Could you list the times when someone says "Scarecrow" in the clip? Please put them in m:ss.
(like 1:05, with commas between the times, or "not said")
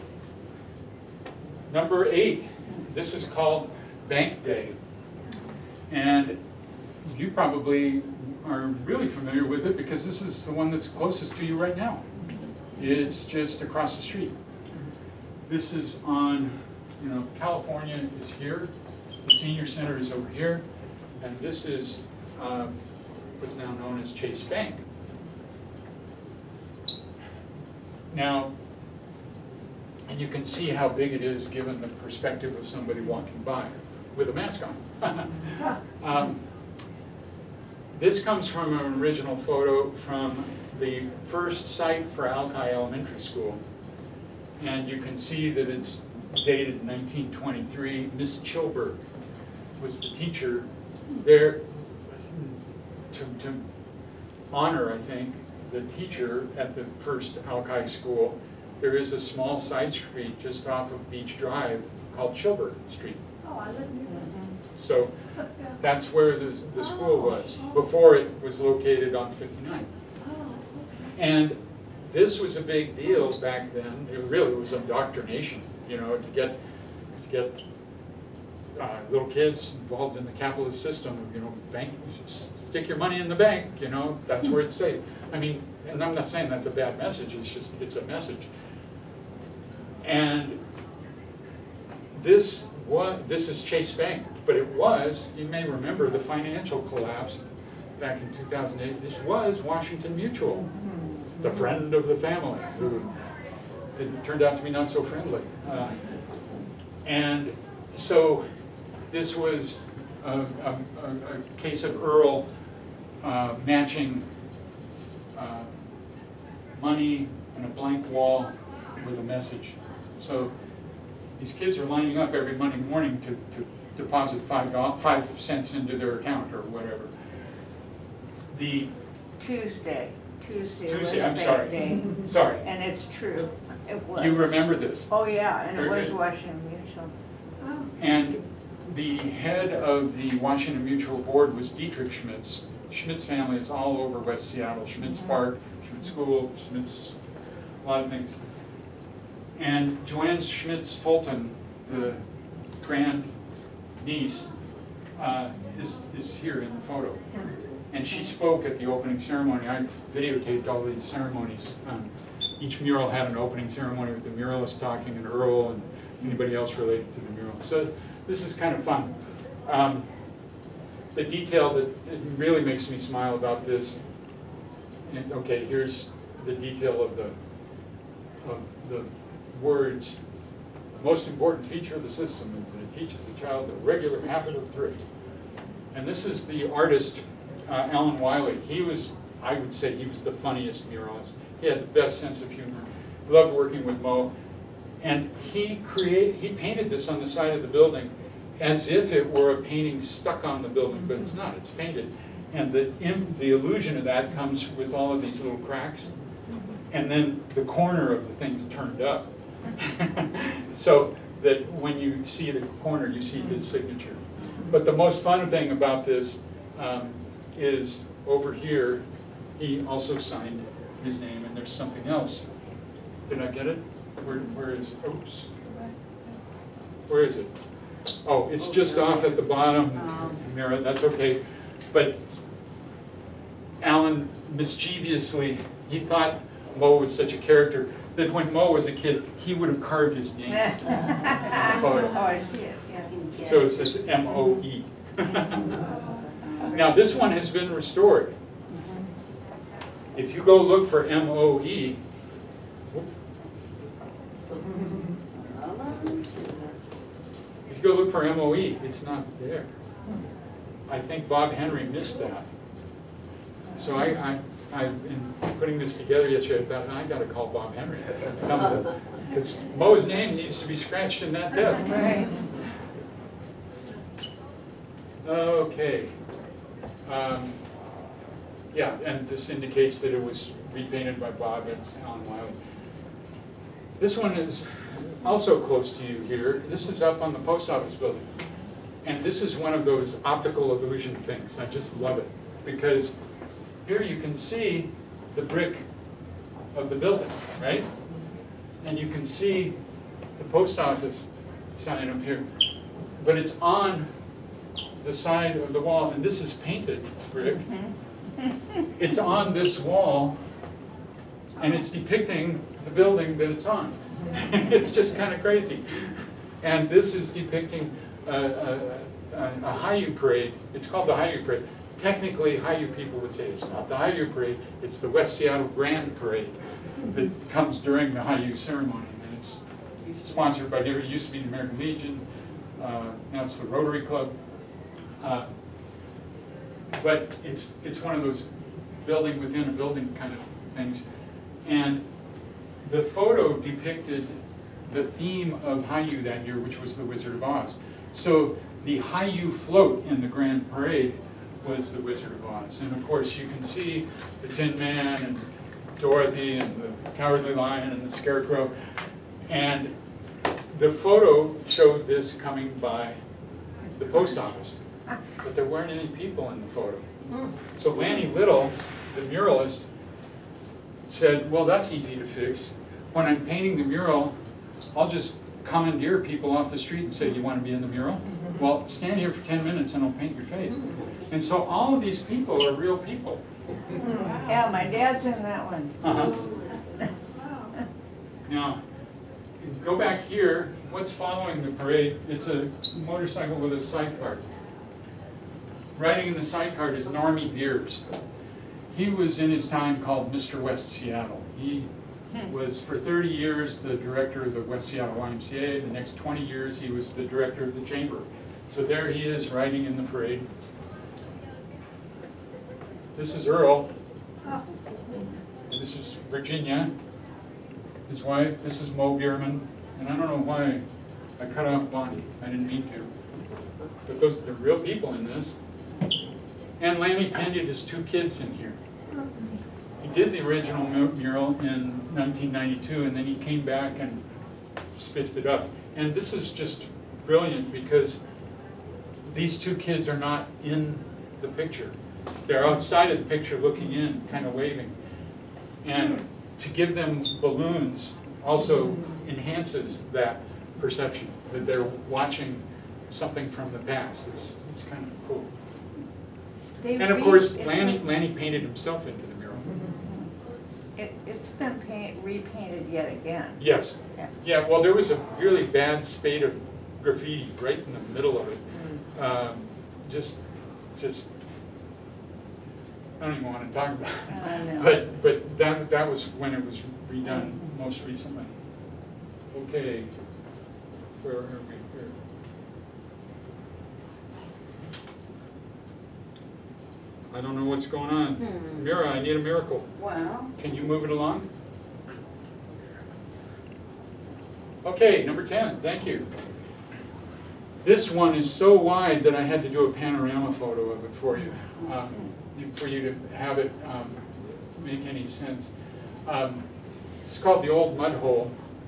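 5:58.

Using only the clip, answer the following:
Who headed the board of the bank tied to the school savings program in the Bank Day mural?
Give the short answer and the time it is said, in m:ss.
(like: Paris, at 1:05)
Dietrich Schmitz, at 2:21.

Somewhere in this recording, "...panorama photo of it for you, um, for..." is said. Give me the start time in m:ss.
8:19.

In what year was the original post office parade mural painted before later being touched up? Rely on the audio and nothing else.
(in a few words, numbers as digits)
1992.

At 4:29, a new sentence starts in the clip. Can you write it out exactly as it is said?
Because Moe's name needs to be scratched in that desk.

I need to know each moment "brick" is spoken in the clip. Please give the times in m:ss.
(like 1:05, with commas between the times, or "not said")
4:55, 5:07.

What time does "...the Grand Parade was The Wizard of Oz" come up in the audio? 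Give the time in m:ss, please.
5:50.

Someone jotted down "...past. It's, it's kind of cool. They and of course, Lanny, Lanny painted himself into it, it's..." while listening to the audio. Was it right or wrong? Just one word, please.
right.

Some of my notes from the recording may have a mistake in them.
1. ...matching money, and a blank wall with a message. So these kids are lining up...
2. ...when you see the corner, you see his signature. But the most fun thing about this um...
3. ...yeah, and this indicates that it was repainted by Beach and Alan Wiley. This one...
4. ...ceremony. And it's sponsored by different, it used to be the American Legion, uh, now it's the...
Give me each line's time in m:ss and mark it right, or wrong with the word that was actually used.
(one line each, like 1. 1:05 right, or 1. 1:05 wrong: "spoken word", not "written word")
1. 1:53 right
2. 3:31 right
3. 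4:38 wrong: "Bob", not "Beach"
4. 5:28 right.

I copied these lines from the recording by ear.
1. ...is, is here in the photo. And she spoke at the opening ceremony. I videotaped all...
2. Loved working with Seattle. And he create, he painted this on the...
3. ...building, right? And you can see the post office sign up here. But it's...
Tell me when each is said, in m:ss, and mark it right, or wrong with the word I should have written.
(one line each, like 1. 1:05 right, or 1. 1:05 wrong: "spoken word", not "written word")
1. 2:35 right
2. 3:13 wrong: "Moe", not "Seattle"
3. 4:56 right.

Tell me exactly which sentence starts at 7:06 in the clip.
And Lanny Pena, his two kids in here.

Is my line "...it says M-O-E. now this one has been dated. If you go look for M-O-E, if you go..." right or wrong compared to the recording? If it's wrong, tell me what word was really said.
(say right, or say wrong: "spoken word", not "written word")
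wrong: "restored", not "dated".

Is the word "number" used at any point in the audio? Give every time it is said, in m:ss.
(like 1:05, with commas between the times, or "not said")
0:01, 8:15.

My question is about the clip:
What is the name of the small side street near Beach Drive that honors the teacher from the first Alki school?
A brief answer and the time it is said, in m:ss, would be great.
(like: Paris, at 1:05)
Chilberg Street, at 1:02.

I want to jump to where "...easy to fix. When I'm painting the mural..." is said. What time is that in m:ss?
6:11.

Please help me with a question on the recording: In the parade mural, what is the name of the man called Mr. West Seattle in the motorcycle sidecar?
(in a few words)
Normie Beers.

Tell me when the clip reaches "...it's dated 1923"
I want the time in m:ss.
0:45.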